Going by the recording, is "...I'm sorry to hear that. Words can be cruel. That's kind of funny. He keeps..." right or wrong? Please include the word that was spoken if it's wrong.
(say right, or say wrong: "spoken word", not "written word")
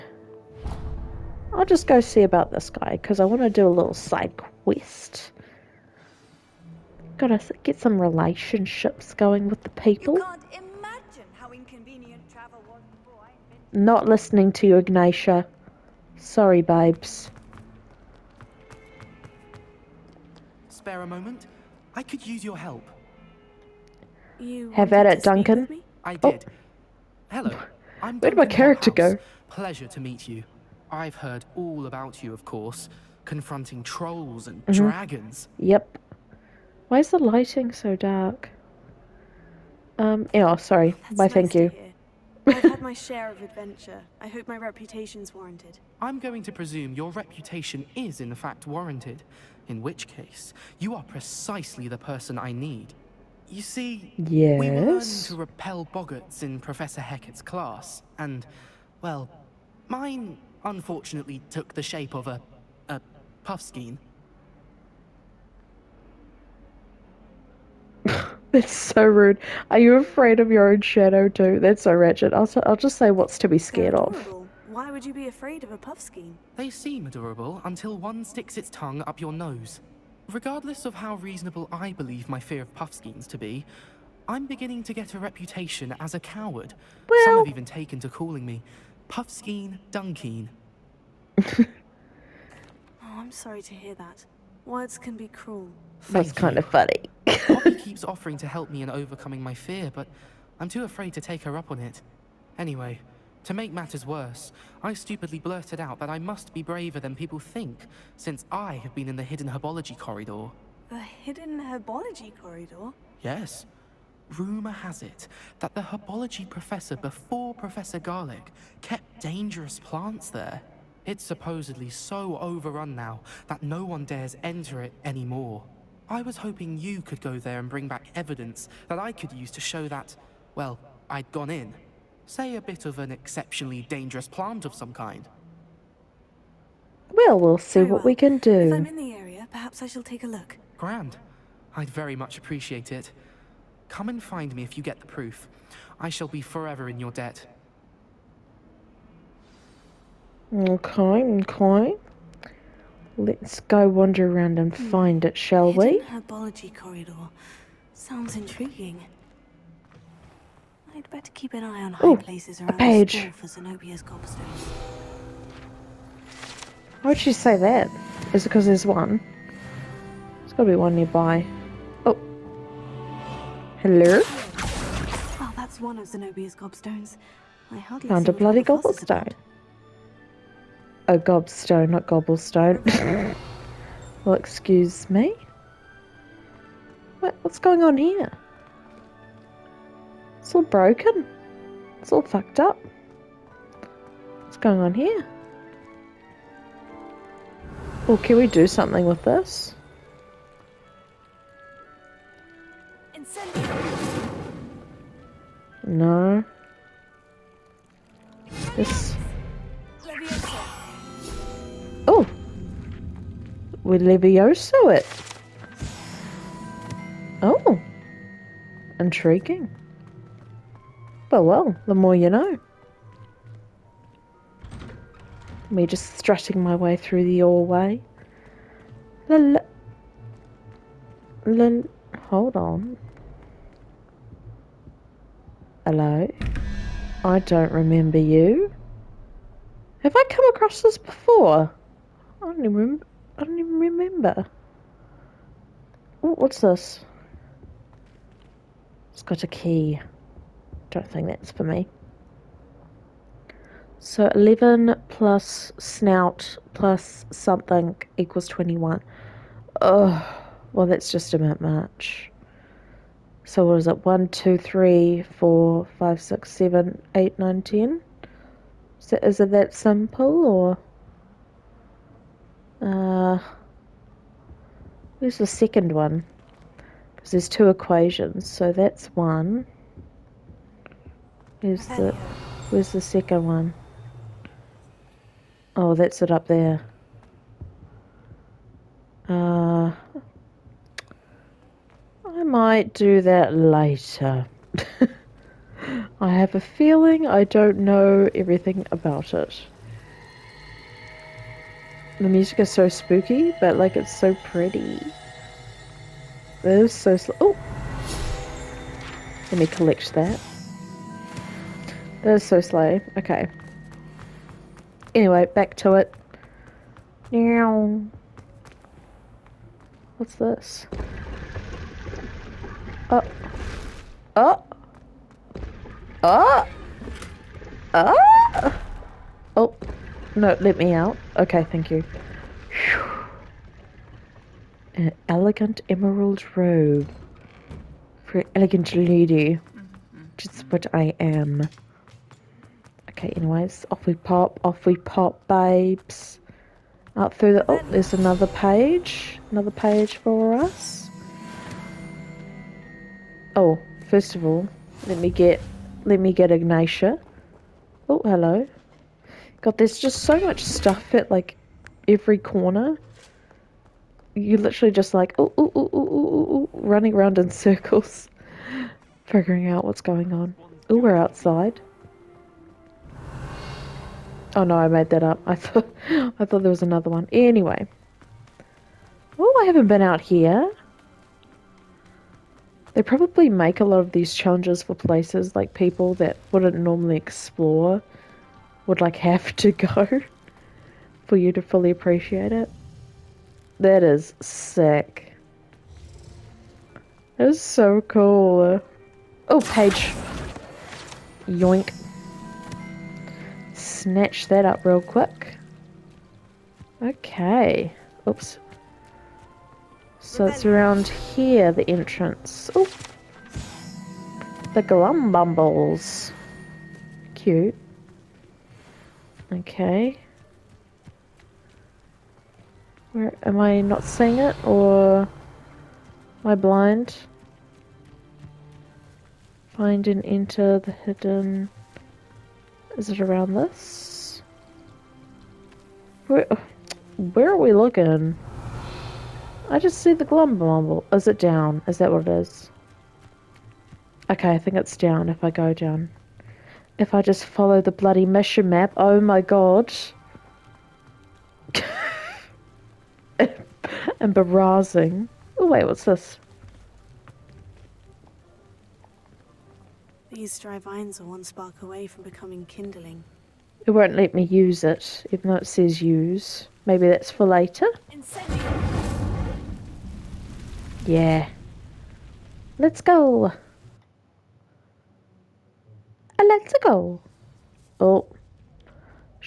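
right.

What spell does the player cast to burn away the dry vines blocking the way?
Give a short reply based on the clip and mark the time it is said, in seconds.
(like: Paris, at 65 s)
Incendium, at 468 s.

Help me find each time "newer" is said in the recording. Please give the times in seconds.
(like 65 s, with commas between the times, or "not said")
not said.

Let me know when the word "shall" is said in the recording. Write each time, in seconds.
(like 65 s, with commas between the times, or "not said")
139 s, 146 s, 155 s.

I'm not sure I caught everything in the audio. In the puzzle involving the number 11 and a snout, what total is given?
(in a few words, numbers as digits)
21.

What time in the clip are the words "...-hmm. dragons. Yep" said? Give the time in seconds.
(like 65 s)
34 s.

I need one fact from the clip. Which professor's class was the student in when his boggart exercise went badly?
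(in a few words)
Professor Hecat.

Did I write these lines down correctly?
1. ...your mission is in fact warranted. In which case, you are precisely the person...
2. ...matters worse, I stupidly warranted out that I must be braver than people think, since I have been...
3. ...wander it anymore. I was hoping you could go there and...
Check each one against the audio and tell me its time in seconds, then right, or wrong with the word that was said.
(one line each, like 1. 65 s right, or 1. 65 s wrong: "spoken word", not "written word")
1. 46 s wrong: "reputation", not "mission"
2. 103 s wrong: "blurted", not "warranted"
3. 124 s wrong: "enter", not "wander".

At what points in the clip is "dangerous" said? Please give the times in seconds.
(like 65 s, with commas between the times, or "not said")
119 s, 133 s.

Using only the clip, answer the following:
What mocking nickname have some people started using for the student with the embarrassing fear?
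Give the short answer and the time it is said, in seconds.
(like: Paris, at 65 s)
Puffskein Dunkeen, at 89 s.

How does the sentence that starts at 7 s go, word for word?
Gotta get some relationships going with the people.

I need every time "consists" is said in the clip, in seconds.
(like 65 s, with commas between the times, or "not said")
not said.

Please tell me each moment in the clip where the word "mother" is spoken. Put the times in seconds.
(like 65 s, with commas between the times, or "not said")
not said.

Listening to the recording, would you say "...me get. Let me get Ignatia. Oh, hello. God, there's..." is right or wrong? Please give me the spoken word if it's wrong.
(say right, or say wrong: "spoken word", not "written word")
right.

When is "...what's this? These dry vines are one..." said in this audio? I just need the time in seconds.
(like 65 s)
455 s.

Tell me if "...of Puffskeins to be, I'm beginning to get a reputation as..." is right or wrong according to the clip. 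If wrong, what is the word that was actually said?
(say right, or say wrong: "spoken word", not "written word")
right.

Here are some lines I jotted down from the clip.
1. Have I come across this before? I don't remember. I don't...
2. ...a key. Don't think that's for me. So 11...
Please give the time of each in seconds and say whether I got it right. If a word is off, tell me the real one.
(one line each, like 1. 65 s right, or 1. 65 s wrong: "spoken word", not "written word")
1. 240 s right
2. 249 s right.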